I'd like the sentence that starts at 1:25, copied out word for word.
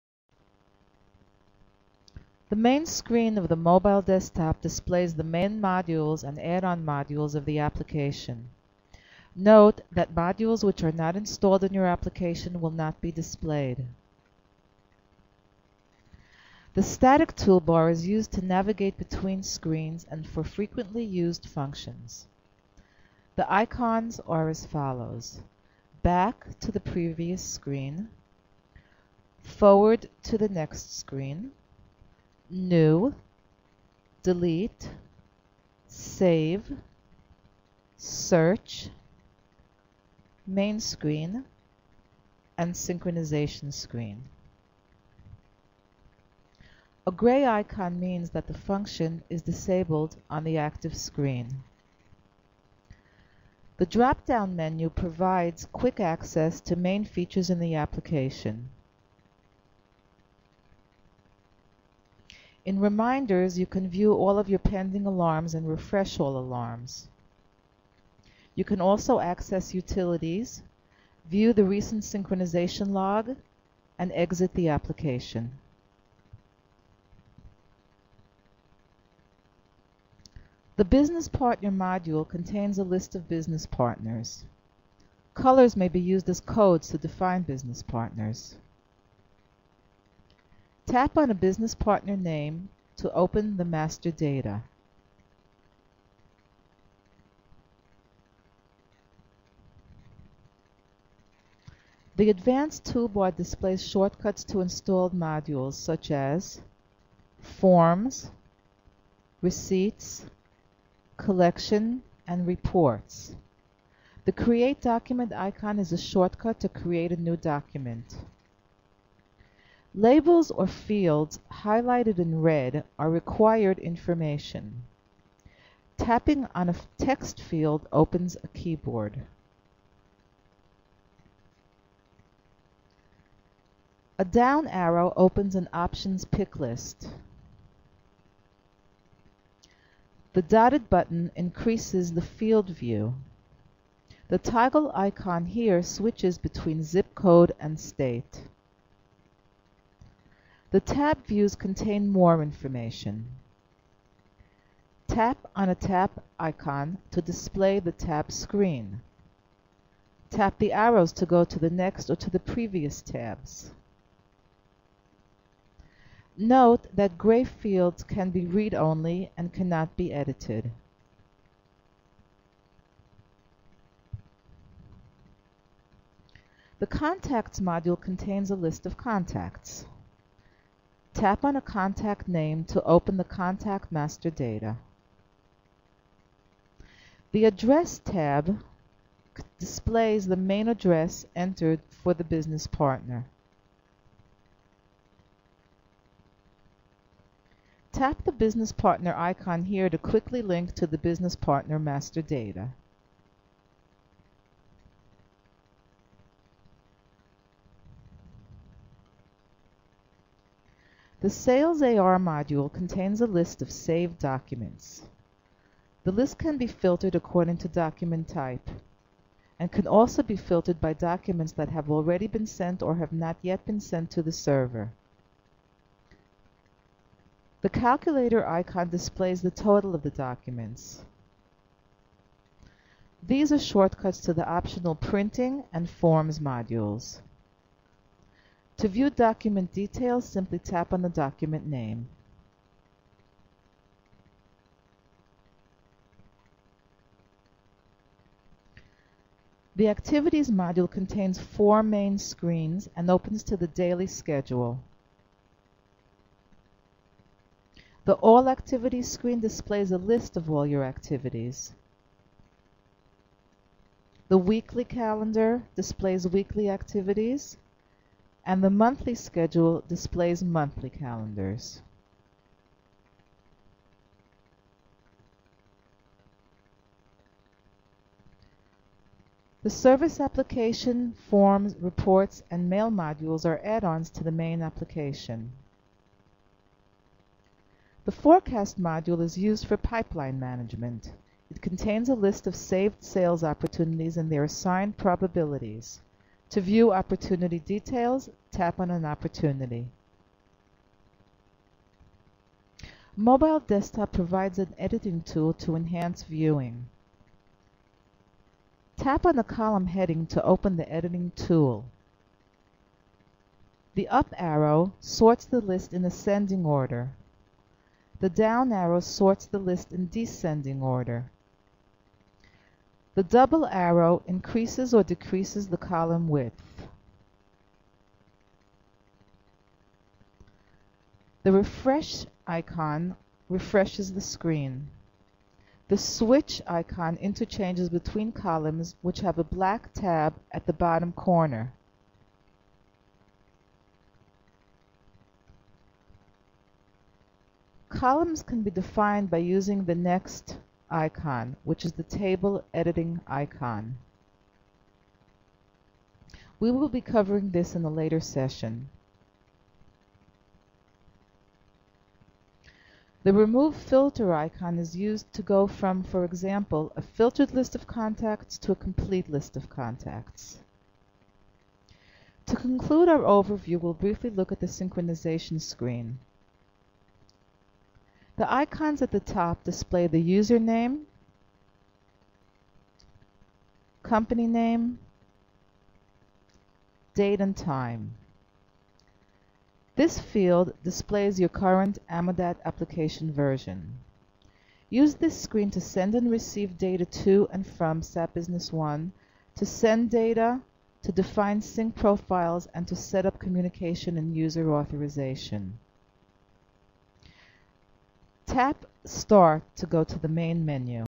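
Colors may be used as codes to define business partners.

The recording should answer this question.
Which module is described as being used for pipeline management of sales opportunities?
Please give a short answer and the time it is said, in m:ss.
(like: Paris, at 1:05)
The forecast module, at 4:48.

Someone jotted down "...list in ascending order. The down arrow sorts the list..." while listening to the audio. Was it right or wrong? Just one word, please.
right.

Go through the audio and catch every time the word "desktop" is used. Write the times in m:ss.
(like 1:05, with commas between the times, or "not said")
0:04, 5:03.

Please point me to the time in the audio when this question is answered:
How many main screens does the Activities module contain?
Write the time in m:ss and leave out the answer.
4:11.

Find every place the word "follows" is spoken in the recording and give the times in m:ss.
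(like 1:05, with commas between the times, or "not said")
0:24.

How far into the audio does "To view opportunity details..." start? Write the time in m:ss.
4:56.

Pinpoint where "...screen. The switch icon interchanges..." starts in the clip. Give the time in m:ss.
5:34.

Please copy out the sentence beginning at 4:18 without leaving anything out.
The All Activities screen displays a list of all your activities.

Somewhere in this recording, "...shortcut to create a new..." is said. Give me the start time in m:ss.
1:55.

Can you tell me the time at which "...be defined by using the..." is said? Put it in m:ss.
5:48.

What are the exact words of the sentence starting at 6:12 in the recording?
To conclude our overview, we'll briefly look at the synchronization screen.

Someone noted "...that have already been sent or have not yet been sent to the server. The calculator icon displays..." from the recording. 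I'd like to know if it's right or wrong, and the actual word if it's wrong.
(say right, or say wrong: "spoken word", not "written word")
right.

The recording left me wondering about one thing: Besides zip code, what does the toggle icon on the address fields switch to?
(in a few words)
State.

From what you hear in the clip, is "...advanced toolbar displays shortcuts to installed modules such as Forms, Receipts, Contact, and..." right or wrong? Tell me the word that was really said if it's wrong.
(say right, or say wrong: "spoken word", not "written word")
wrong: "Collection", not "Contact".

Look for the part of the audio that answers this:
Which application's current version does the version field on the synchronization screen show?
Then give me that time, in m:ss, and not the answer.
6:32.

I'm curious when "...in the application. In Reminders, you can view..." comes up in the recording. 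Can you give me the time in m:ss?
0:57.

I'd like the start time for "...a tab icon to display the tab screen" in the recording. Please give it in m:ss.
2:35.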